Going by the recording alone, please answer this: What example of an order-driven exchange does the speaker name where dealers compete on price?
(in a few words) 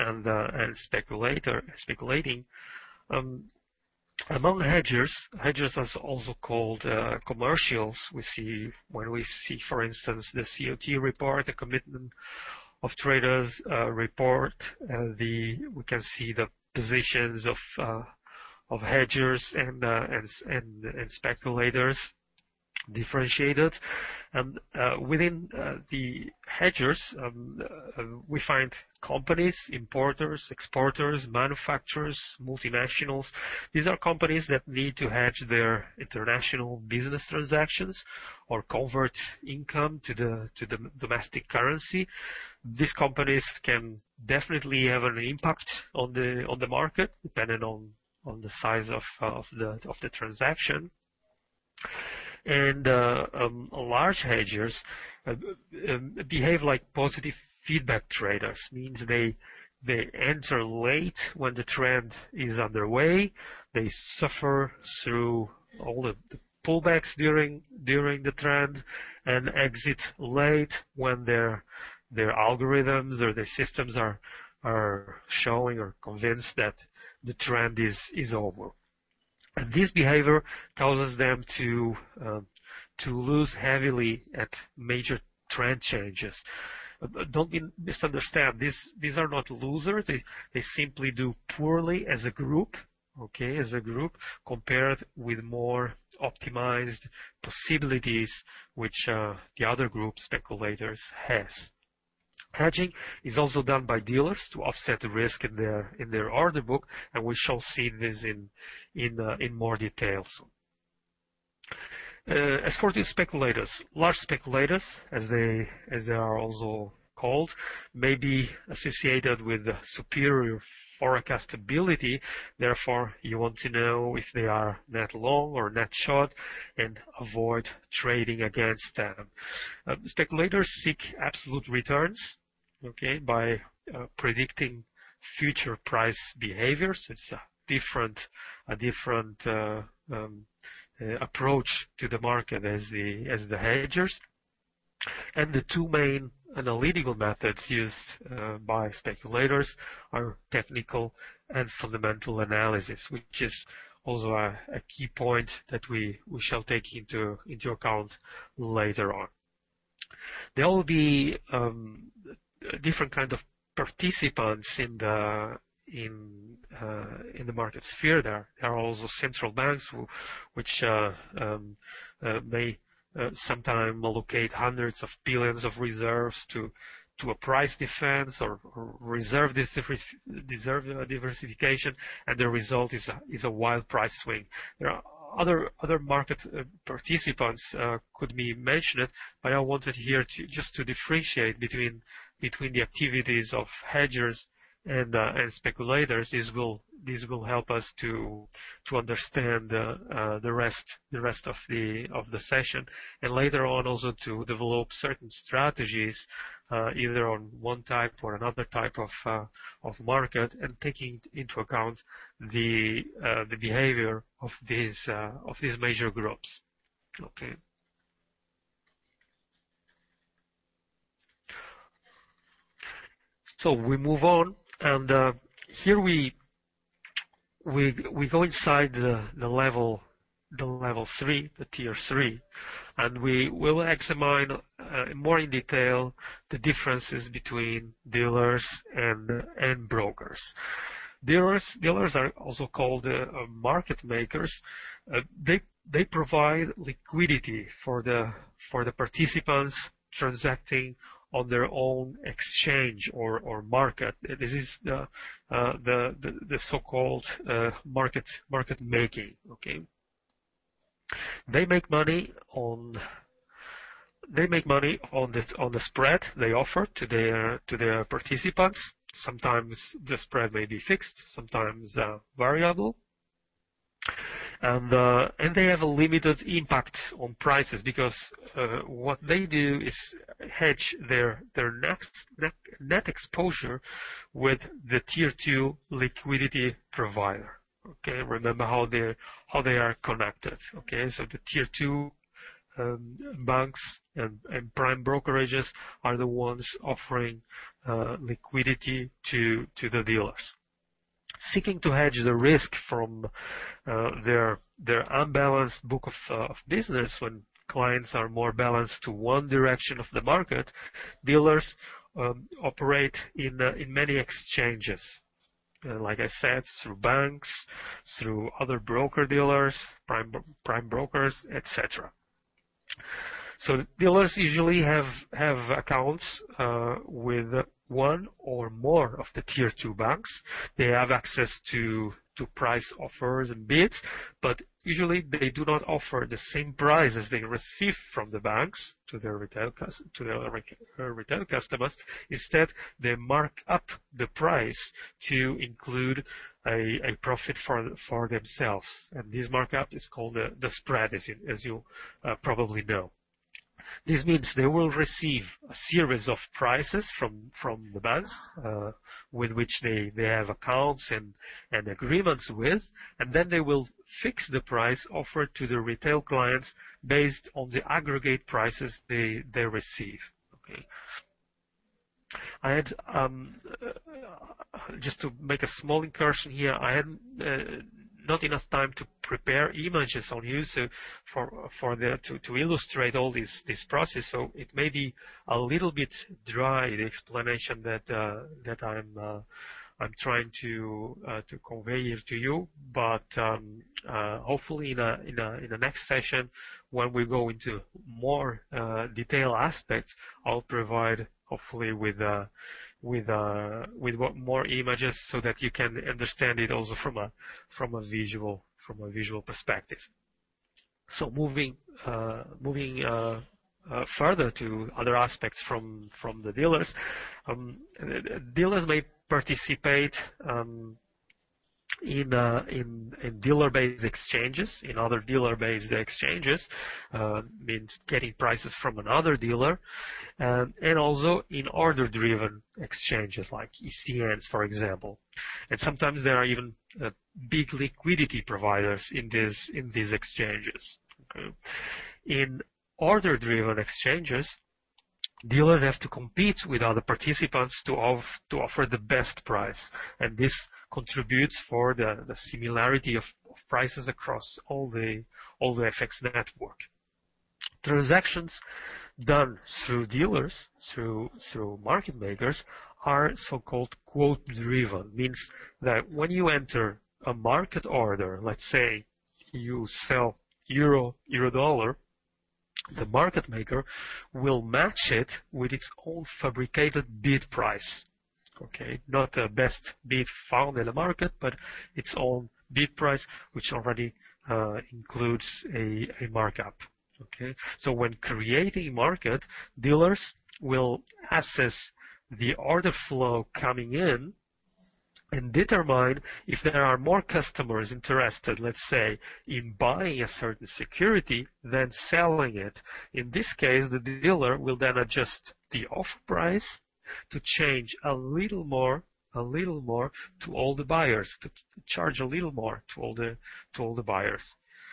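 ECNs.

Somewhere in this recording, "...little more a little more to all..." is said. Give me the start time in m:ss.
8:28.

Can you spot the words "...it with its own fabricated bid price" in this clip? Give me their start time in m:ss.
7:55.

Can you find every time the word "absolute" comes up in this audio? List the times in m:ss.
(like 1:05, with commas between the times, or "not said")
2:11.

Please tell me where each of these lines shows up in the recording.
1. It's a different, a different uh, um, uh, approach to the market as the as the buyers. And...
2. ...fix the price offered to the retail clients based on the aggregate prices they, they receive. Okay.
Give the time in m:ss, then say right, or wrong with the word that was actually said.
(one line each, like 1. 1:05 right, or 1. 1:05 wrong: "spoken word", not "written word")
1. 2:17 wrong: "hedgers", not "buyers"
2. 6:04 right.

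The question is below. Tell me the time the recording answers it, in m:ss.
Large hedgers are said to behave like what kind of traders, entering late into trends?
0:56.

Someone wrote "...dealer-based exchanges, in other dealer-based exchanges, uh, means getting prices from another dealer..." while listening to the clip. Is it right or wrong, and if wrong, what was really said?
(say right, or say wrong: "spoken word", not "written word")
right.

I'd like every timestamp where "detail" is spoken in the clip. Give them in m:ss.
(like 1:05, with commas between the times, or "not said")
1:49, 3:55, 6:39.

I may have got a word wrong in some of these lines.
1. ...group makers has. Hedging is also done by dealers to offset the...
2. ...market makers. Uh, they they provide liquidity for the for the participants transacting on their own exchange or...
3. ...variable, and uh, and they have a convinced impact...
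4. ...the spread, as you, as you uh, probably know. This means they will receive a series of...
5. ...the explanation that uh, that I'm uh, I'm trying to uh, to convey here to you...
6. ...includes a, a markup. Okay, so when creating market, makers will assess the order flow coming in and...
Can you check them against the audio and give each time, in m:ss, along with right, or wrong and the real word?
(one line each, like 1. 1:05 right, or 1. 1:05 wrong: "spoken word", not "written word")
1. 1:39 wrong: "speculators", not "makers"
2. 4:03 right
3. 4:32 wrong: "limited", not "convinced"
4. 5:50 right
5. 6:26 right
6. 8:04 wrong: "dealers", not "makers".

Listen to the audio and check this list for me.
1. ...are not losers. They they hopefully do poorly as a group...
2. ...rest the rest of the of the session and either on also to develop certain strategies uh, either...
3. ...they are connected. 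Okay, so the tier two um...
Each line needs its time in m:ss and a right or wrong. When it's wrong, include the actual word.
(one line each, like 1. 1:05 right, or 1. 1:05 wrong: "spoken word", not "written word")
1. 1:29 wrong: "simply", not "hopefully"
2. 3:20 wrong: "later", not "either"
3. 4:49 right.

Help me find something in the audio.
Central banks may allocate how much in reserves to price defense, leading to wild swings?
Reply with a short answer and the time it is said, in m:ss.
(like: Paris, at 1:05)
Hundreds of billions, at 2:54.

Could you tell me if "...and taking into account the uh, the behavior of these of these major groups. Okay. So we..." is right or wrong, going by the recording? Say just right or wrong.
right.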